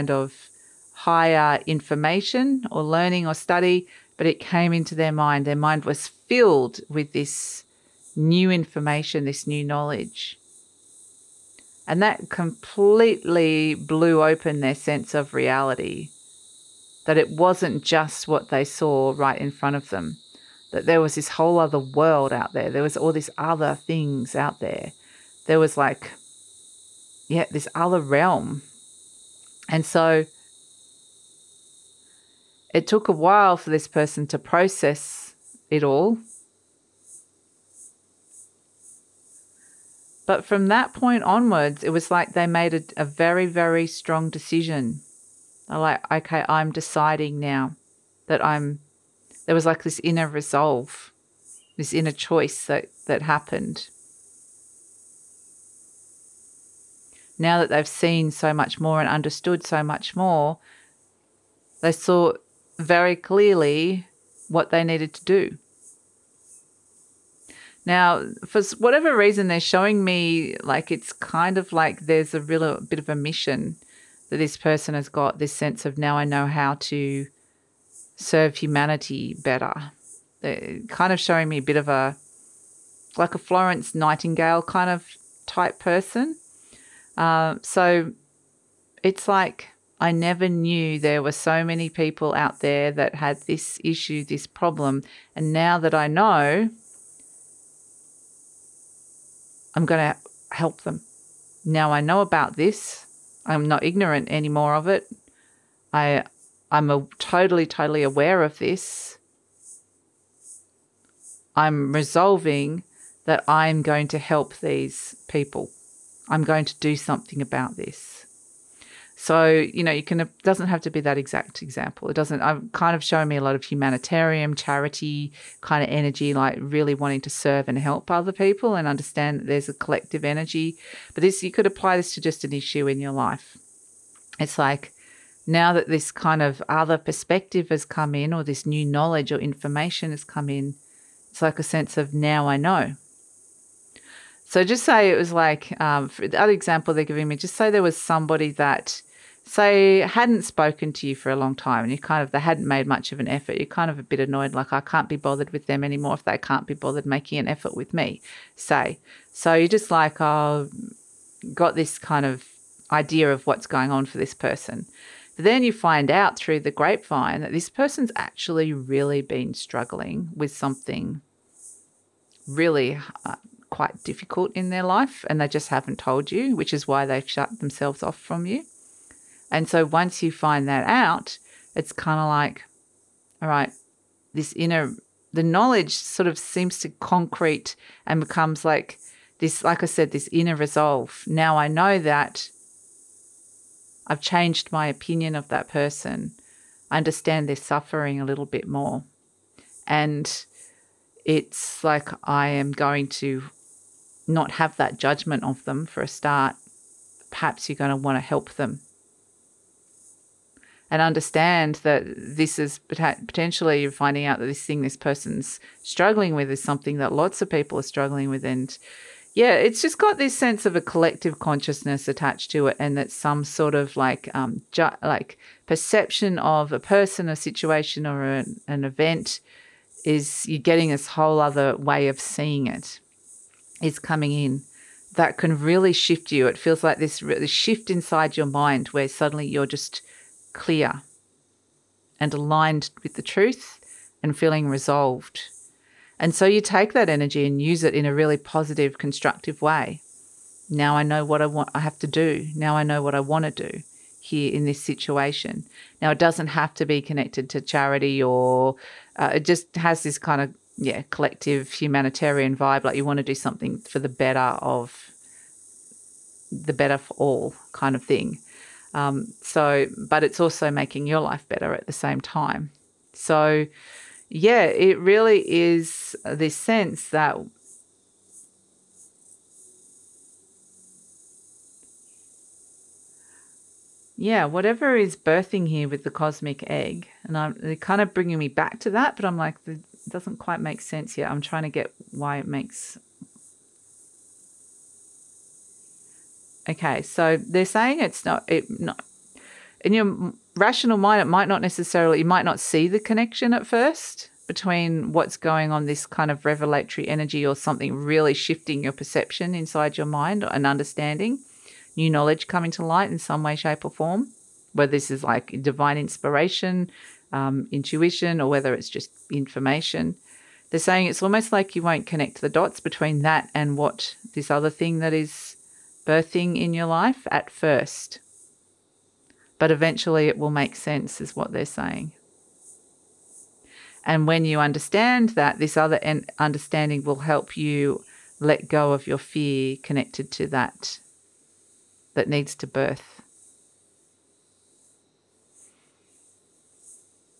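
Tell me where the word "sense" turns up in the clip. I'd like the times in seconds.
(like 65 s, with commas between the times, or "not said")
14 s, 75 s, 141 s, 220 s, 276 s, 290 s, 330 s.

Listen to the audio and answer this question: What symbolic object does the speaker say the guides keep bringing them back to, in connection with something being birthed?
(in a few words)
The cosmic egg.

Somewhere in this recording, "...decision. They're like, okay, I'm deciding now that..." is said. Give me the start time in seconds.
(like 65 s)
44 s.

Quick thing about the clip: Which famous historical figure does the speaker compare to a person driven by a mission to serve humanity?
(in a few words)
Florence Nightingale.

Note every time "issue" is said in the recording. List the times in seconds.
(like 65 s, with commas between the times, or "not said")
93 s, 132 s.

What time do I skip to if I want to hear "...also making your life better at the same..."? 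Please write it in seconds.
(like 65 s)
270 s.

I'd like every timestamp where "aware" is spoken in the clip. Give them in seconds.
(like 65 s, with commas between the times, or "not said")
108 s.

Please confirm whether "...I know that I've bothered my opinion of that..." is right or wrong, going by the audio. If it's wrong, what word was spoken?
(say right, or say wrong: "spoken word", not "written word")
wrong: "changed", not "bothered".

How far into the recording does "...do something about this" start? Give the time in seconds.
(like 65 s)
116 s.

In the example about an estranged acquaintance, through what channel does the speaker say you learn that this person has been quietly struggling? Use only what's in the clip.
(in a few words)
The grapevine.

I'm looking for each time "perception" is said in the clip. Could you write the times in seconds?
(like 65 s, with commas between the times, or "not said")
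225 s, 308 s.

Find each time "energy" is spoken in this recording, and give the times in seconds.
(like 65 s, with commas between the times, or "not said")
125 s, 130 s, 247 s, 307 s.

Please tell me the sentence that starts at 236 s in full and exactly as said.
It feels like this, this shift inside your mind where suddenly you're just clear and aligned with the truth and feeling resolved.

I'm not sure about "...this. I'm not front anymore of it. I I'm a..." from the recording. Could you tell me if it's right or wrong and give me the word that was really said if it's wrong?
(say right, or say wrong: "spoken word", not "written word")
wrong: "ignorant", not "front".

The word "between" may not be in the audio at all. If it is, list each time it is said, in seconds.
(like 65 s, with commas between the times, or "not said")
304 s, 322 s.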